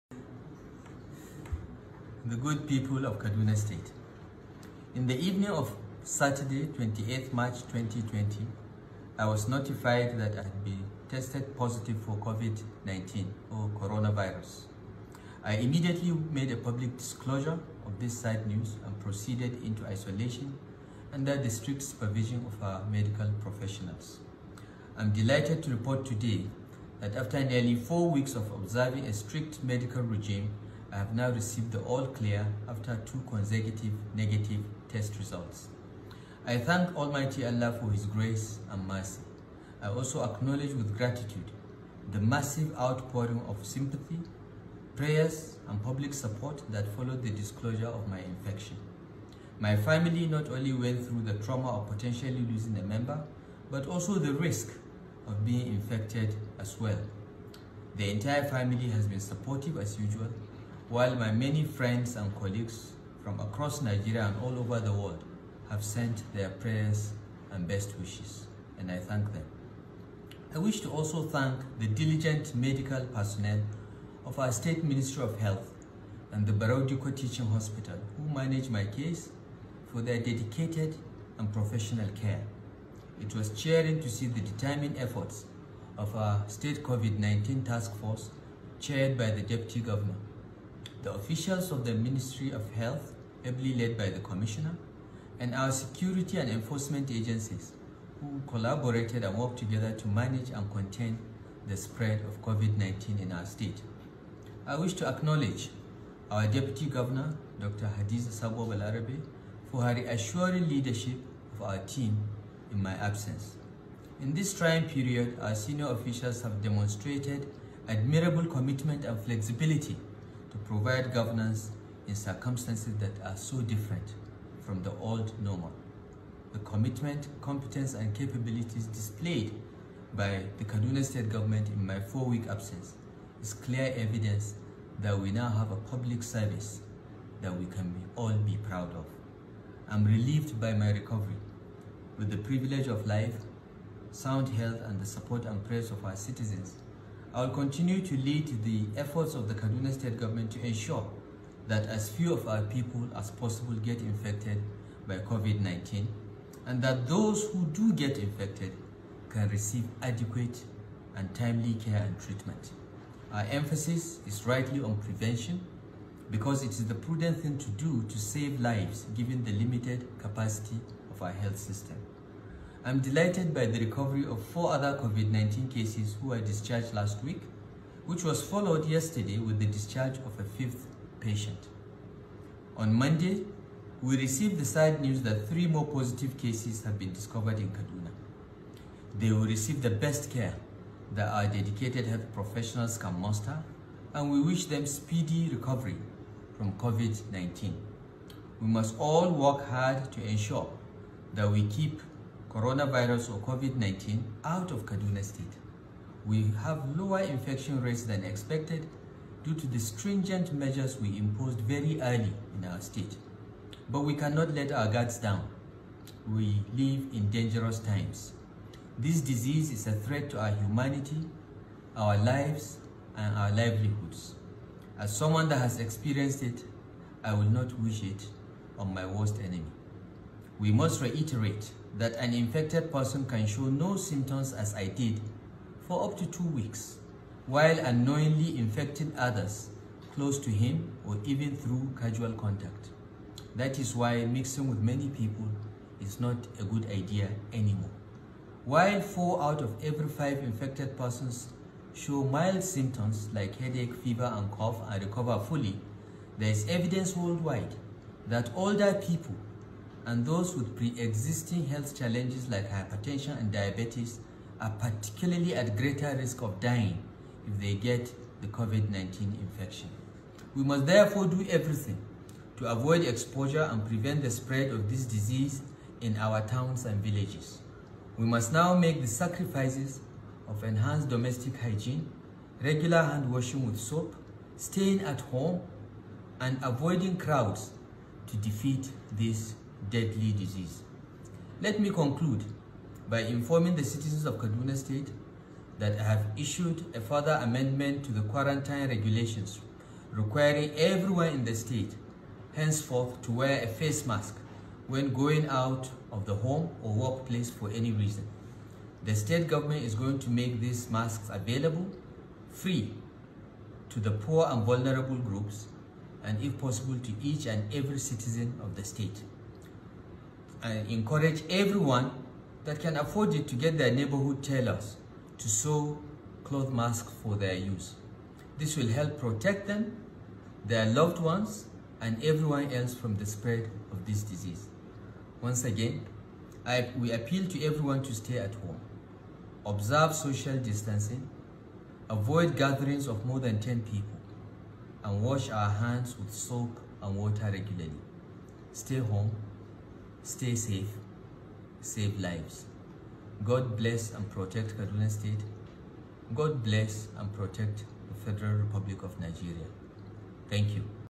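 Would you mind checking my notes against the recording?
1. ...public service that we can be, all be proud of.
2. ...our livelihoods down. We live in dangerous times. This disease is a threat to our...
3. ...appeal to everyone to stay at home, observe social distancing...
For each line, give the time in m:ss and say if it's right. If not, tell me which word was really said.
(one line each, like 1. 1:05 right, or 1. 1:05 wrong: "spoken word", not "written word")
1. 2:15 right
2. 3:34 wrong: "guards", not "livelihoods"
3. 5:37 right.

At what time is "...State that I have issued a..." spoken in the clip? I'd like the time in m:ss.
4:54.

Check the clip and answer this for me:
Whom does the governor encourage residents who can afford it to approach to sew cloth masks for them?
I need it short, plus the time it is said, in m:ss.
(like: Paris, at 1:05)
neighborhood tailors, at 5:23.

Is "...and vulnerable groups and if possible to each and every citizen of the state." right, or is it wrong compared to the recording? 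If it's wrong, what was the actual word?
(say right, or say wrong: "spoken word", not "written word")
right.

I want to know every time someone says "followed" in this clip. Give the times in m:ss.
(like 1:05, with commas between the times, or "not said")
0:46, 2:58.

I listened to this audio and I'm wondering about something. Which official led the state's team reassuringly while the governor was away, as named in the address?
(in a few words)
Dr. Hadiza Sabo Balarabe.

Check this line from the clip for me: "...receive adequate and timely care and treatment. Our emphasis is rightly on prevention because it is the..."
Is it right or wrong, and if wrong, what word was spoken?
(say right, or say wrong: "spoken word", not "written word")
right.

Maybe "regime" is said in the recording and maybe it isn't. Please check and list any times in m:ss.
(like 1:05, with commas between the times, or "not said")
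0:30.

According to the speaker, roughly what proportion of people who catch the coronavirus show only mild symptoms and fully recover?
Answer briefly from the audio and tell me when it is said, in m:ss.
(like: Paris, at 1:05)
4 out of every 5, at 4:09.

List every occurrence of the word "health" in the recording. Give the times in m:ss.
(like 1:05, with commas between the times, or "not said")
1:15, 1:32, 2:24, 2:51, 3:12, 4:21.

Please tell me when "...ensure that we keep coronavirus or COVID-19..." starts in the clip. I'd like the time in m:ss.
3:20.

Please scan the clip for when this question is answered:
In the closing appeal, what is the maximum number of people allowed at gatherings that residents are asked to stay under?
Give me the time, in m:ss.
5:43.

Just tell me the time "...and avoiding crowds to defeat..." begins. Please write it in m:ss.
4:46.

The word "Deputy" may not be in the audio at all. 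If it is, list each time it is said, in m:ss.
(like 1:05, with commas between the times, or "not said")
1:29, 1:46.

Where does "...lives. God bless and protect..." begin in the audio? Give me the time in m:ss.
5:52.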